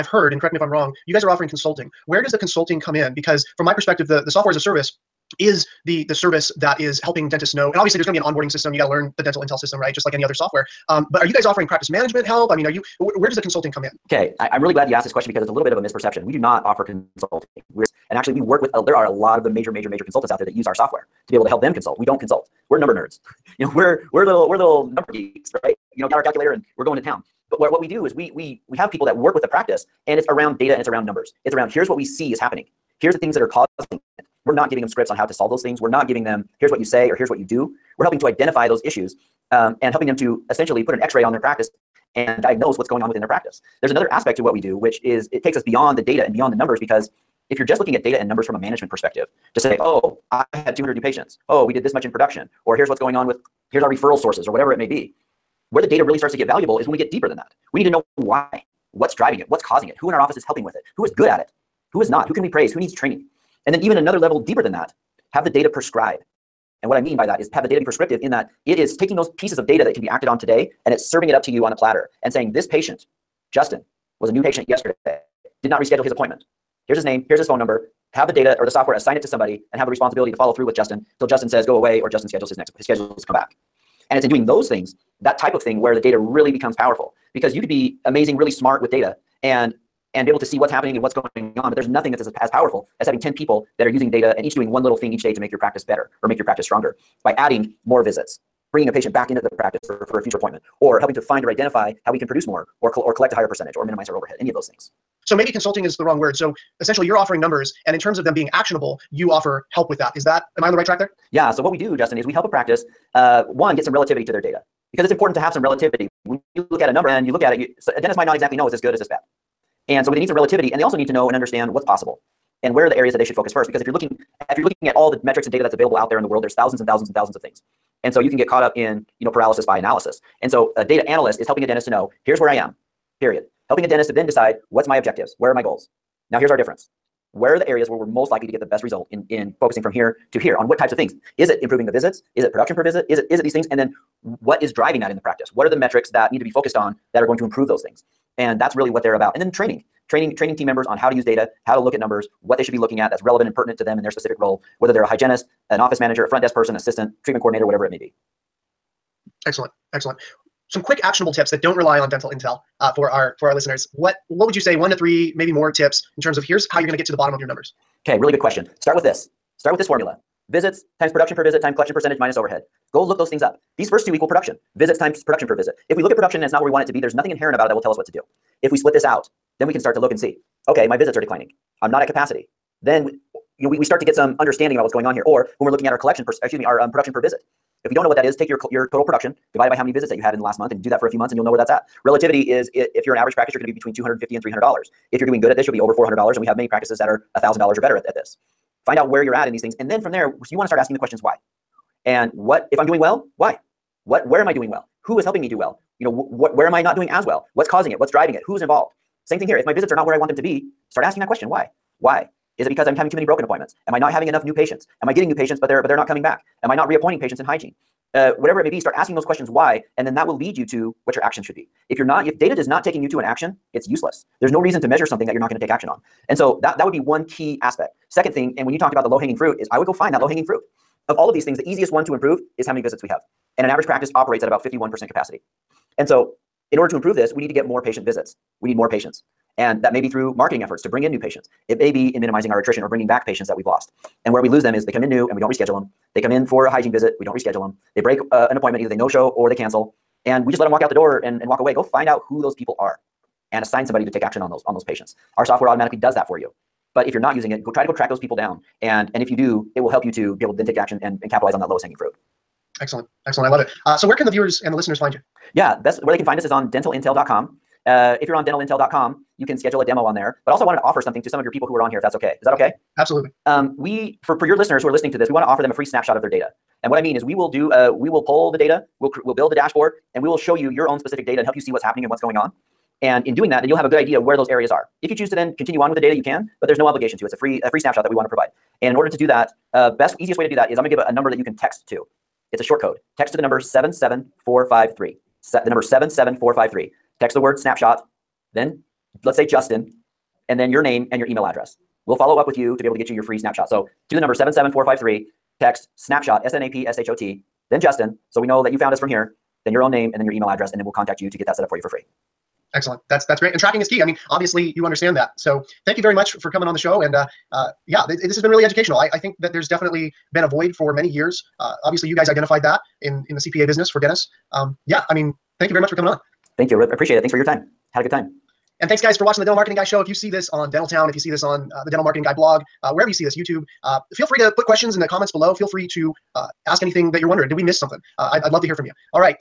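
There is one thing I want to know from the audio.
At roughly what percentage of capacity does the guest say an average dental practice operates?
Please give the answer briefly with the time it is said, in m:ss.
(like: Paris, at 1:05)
51%, at 3:54.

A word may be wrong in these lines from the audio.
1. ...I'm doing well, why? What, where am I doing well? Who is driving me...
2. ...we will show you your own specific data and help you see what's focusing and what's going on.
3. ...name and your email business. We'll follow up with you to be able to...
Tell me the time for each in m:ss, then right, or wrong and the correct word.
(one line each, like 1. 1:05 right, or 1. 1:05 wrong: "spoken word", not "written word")
1. 3:22 wrong: "helping", not "driving"
2. 4:40 wrong: "happening", not "focusing"
3. 5:00 wrong: "address", not "business".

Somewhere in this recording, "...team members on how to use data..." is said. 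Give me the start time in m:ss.
2:30.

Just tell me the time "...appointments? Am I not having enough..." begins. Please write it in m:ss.
3:33.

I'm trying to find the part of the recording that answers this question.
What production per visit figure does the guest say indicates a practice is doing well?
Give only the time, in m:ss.
3:15.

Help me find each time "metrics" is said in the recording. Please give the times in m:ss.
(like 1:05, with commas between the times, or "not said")
2:05, 2:25.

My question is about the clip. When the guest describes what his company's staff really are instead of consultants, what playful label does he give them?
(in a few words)
Number nerds.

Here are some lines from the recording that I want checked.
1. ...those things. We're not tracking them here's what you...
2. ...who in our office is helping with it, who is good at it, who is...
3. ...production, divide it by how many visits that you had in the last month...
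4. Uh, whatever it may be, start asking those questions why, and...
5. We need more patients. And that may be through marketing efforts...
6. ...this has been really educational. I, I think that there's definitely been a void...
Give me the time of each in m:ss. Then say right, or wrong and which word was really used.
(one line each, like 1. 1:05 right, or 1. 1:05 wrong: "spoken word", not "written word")
1. 0:35 wrong: "giving", not "tracking"
2. 0:59 right
3. 3:09 right
4. 3:38 right
5. 3:58 right
6. 5:18 right.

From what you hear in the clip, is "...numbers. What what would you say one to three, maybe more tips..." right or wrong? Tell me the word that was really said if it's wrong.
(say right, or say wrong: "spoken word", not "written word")
wrong: "listeners", not "numbers".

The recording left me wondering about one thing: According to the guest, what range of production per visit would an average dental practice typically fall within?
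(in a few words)
$250 to $300.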